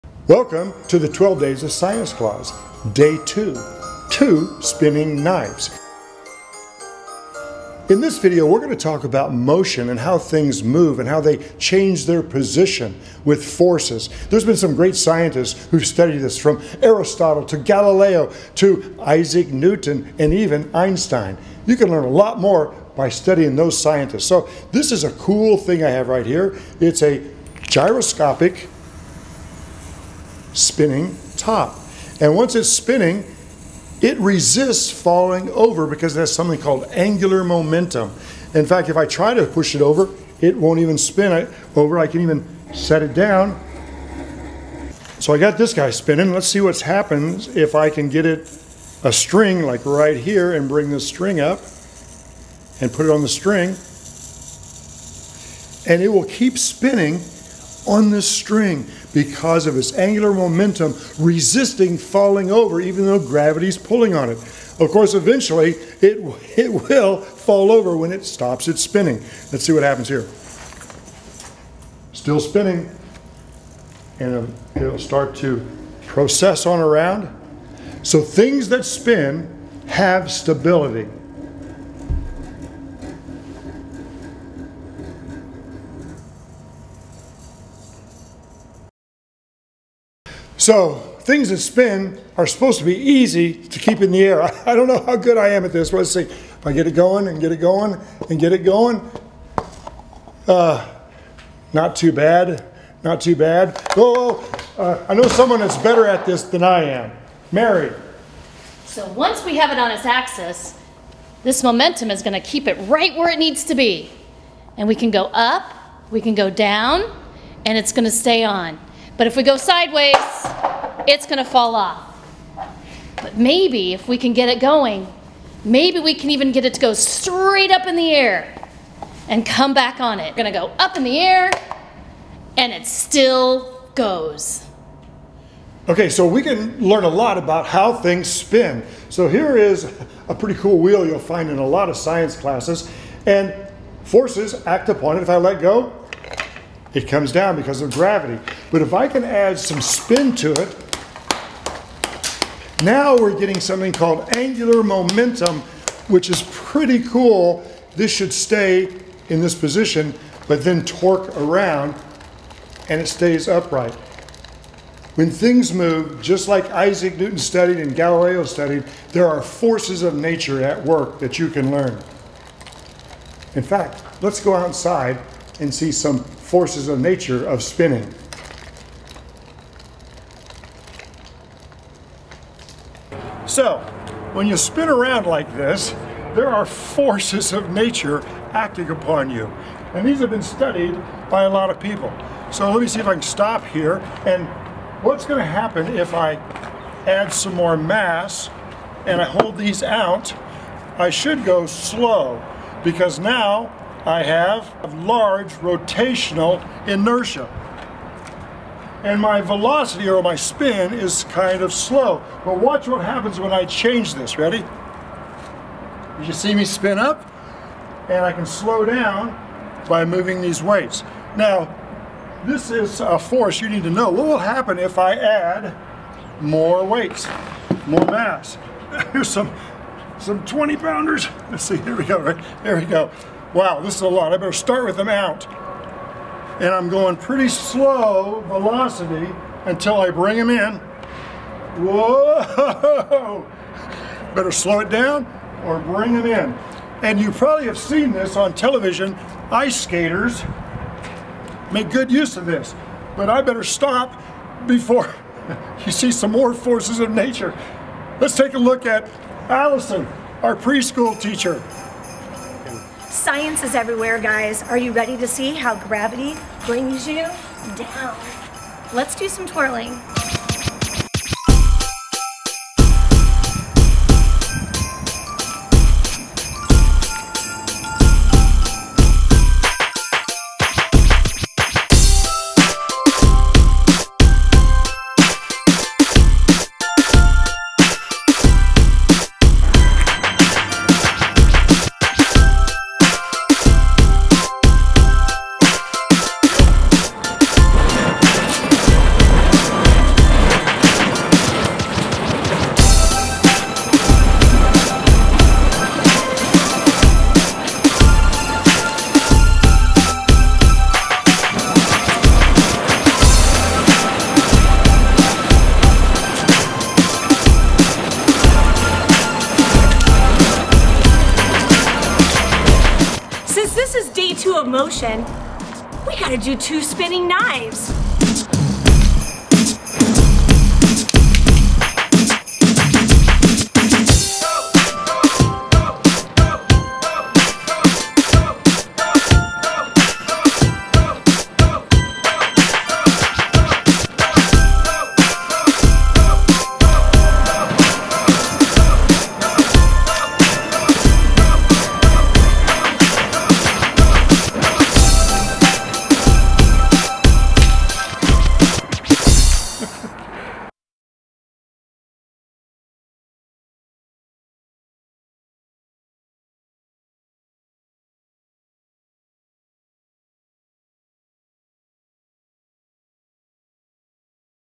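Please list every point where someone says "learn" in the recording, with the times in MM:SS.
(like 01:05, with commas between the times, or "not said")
00:21, 02:16, 02:51.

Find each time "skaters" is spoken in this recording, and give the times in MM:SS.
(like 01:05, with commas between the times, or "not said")
04:09.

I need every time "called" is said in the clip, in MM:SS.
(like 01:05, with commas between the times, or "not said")
00:36, 02:33.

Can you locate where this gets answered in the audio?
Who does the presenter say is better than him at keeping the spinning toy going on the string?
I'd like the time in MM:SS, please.
01:47.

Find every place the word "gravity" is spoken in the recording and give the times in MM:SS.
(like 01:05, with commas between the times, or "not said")
01:03, 02:27, 04:25.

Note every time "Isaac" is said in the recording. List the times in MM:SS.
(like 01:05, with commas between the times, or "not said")
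00:19, 02:46.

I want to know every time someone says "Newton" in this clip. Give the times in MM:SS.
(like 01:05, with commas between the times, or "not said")
00:19, 02:47.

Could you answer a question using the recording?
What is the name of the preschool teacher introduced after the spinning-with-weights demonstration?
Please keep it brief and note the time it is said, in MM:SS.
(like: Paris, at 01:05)
Allison, at 04:19.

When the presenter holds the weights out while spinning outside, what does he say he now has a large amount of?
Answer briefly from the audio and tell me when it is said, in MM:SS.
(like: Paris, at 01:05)
rotational inertia, at 03:25.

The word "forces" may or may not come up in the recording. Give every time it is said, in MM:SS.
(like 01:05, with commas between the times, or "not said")
00:13, 02:24, 02:49, 02:56, 03:06, 03:43, 04:16.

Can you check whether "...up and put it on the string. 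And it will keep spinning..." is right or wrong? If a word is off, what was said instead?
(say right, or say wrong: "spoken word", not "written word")
right.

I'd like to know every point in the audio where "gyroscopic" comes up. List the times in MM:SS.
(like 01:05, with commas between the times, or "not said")
00:27.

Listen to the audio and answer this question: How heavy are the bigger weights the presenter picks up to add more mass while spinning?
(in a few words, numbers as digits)
20 pounds.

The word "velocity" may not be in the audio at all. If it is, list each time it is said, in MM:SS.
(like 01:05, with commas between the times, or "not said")
03:29, 03:58.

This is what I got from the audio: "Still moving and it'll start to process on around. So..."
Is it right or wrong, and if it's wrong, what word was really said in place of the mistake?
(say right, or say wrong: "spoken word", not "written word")
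wrong: "spinning", not "moving".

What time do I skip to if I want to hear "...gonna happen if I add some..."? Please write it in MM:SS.
03:15.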